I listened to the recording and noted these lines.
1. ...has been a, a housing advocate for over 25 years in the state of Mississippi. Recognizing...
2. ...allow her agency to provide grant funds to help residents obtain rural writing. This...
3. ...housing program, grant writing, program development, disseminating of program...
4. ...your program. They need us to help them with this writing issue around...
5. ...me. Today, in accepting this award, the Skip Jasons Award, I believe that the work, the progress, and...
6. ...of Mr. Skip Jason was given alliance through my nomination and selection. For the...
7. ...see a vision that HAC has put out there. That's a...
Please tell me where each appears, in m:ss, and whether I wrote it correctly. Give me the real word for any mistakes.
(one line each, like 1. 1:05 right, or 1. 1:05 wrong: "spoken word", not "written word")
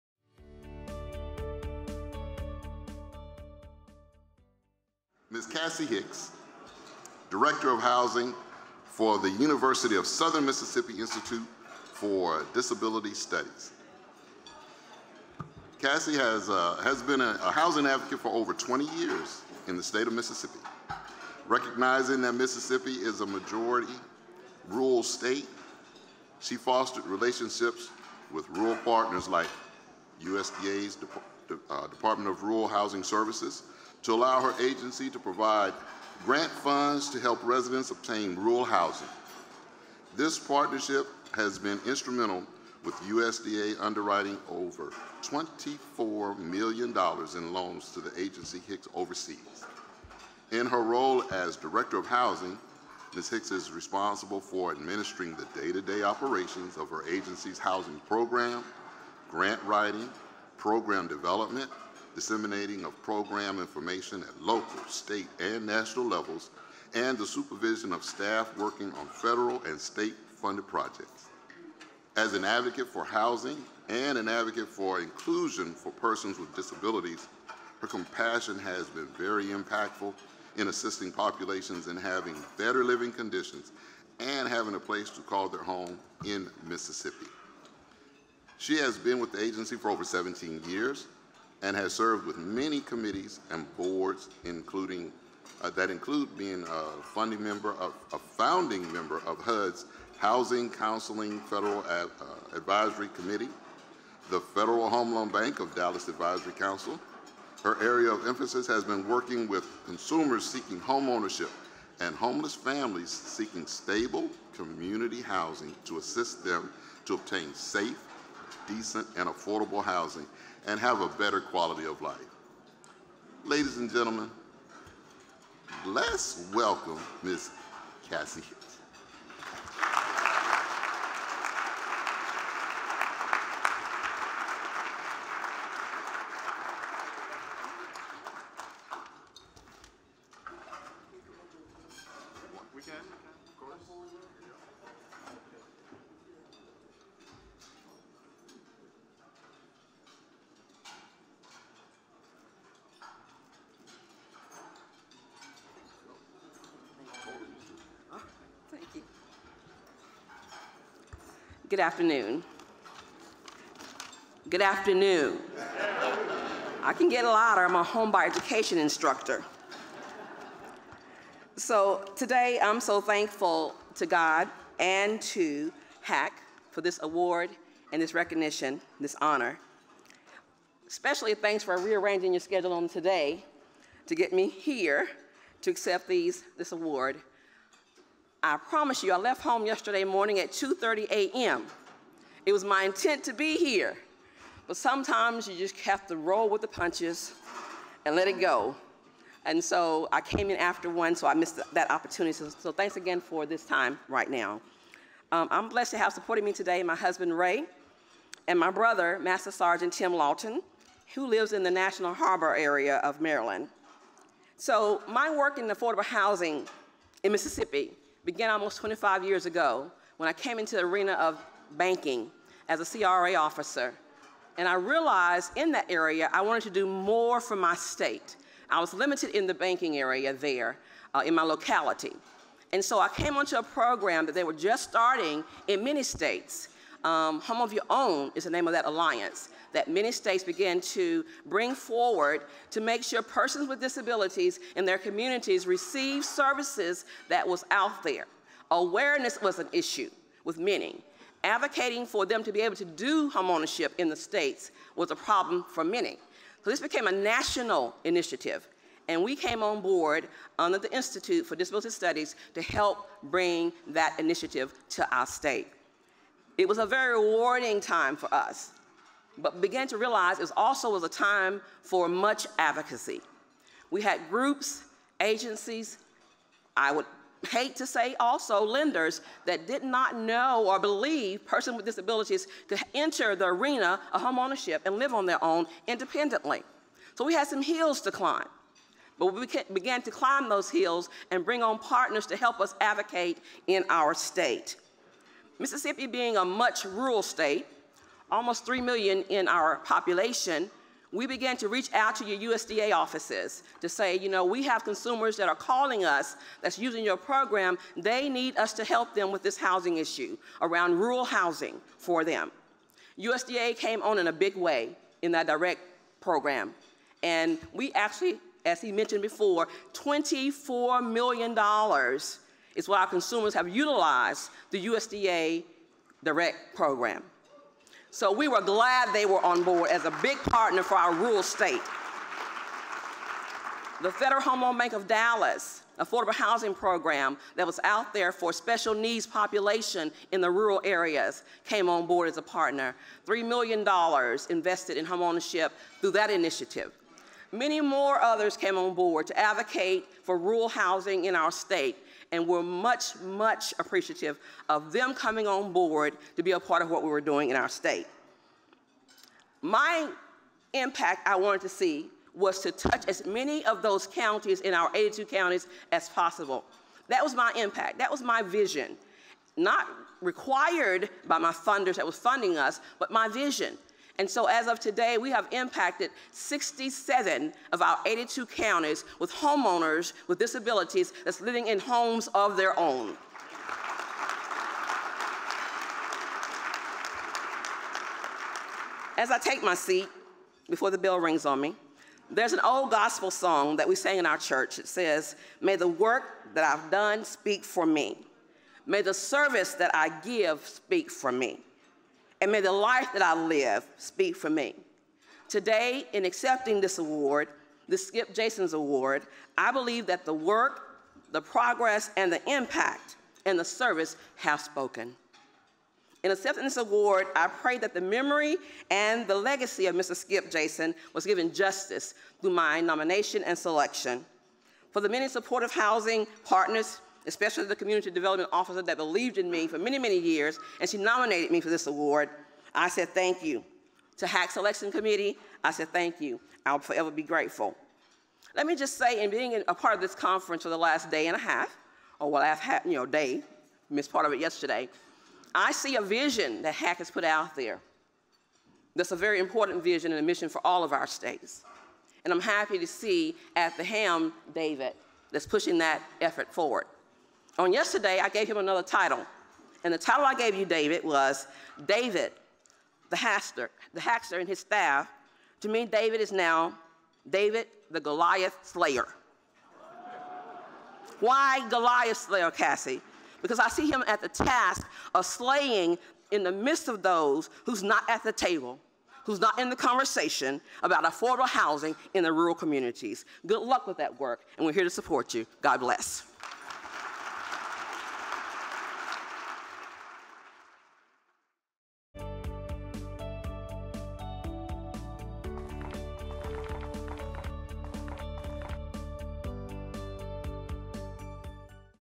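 1. 0:16 wrong: "20", not "25"
2. 0:34 wrong: "housing", not "writing"
3. 0:57 right
4. 5:07 wrong: "housing", not "writing"
5. 6:44 right
6. 6:59 wrong: "justice", not "alliance"
7. 7:25 right.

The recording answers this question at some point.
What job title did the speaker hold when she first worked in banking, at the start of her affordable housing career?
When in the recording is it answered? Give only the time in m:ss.
3:42.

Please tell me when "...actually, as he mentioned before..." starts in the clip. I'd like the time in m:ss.
5:17.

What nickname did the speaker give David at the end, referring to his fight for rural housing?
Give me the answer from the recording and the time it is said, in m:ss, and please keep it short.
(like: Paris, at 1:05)
David, the Goliath Slayer, at 7:47.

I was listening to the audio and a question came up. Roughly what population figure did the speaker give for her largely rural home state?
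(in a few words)
almost 3 million.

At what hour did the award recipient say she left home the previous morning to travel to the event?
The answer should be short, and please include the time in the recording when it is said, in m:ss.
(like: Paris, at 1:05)
2:30 a.m., at 3:10.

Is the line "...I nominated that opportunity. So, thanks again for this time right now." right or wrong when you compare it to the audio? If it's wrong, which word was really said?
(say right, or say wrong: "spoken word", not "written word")
wrong: "missed", not "nominated".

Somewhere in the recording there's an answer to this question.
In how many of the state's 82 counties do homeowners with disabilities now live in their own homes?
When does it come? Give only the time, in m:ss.
6:16.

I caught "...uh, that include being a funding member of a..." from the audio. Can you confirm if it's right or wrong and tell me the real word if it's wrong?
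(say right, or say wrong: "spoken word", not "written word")
right.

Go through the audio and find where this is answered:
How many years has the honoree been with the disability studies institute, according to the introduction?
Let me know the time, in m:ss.
1:29.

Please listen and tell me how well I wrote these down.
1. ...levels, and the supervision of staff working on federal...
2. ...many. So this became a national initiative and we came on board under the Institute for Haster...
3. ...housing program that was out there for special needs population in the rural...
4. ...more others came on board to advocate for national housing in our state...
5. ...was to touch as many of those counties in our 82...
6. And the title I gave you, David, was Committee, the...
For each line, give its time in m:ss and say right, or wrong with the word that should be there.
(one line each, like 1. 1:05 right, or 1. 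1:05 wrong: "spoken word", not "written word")
1. 1:06 right
2. 4:15 wrong: "Disability", not "Haster"
3. 5:36 right
4. 5:47 wrong: "rural", not "national"
5. 6:02 right
6. 7:39 wrong: "David", not "Committee".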